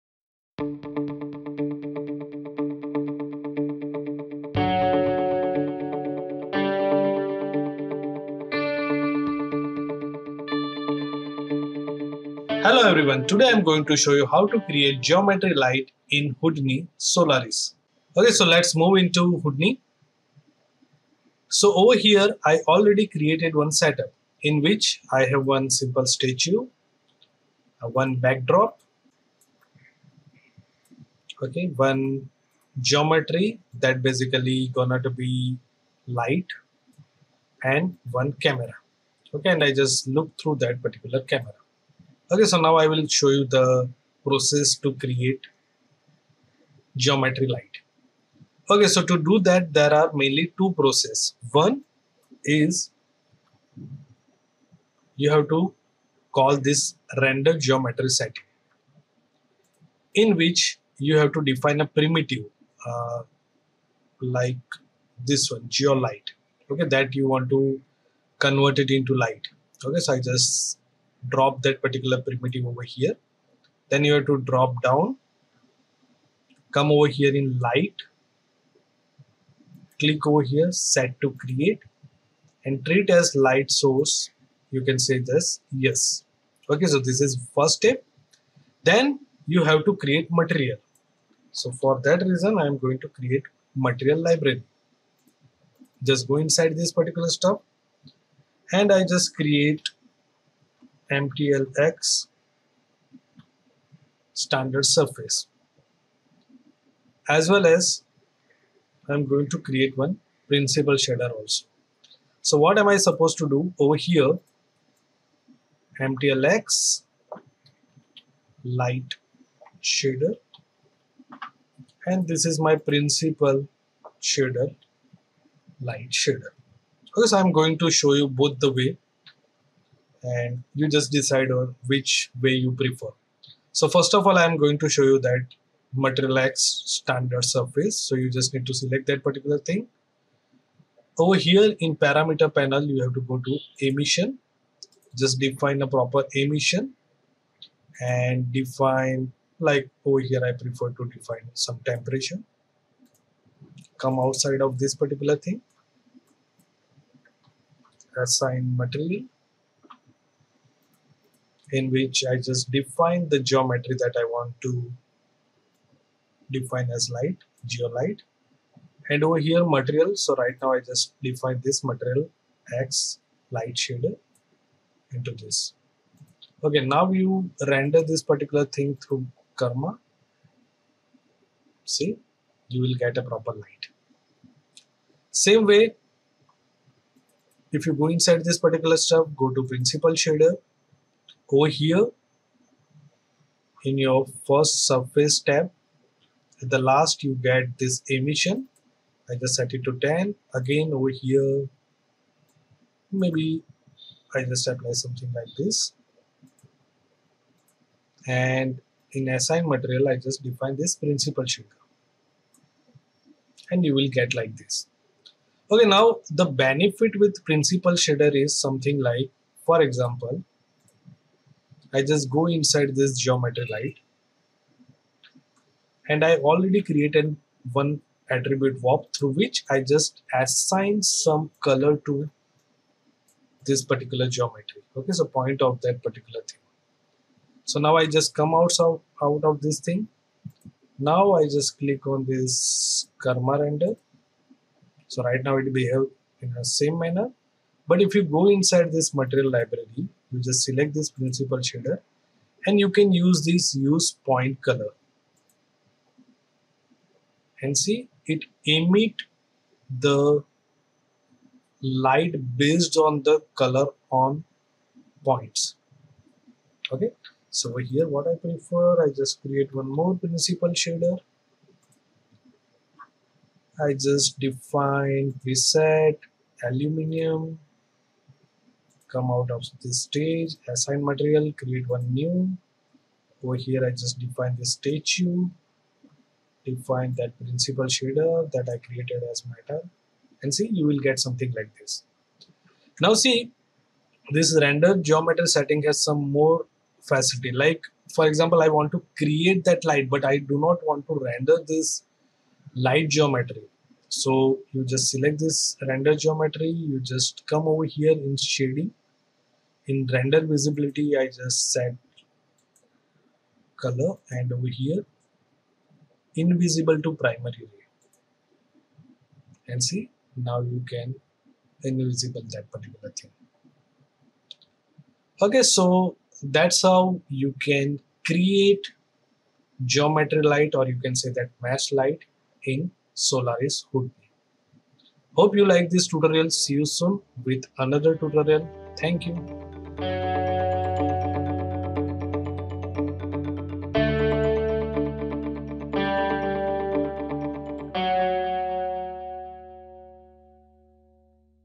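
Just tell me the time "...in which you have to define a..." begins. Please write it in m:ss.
1:00.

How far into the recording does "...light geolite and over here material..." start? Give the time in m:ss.
2:47.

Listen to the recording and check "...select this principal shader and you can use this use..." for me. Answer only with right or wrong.
right.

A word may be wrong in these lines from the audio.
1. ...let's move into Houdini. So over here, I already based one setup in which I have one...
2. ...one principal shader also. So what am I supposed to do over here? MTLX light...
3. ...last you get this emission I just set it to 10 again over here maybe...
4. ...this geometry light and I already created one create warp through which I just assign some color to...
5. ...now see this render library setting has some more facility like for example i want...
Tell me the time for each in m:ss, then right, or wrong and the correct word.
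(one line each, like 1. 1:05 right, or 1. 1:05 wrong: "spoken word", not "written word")
1. 0:18 wrong: "created", not "based"
2. 1:49 right
3. 3:16 right
4. 3:42 wrong: "attribute", not "create"
5. 4:53 wrong: "geometry", not "library".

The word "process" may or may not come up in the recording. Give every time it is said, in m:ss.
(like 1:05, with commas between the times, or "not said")
0:44, 0:50.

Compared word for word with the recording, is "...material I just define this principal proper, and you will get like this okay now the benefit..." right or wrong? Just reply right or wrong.
wrong.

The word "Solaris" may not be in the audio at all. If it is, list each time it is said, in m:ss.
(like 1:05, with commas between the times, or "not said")
0:16, 5:33.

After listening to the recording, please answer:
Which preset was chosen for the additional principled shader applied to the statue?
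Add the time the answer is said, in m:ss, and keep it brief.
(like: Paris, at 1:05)
aluminum, at 4:36.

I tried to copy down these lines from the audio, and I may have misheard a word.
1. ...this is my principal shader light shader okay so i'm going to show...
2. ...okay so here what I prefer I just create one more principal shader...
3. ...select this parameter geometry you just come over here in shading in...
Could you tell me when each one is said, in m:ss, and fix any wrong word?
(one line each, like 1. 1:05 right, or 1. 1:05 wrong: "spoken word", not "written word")
1. 2:02 right
2. 4:26 right
3. 5:05 wrong: "render", not "parameter".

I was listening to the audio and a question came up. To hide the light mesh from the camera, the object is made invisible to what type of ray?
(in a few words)
primary ray.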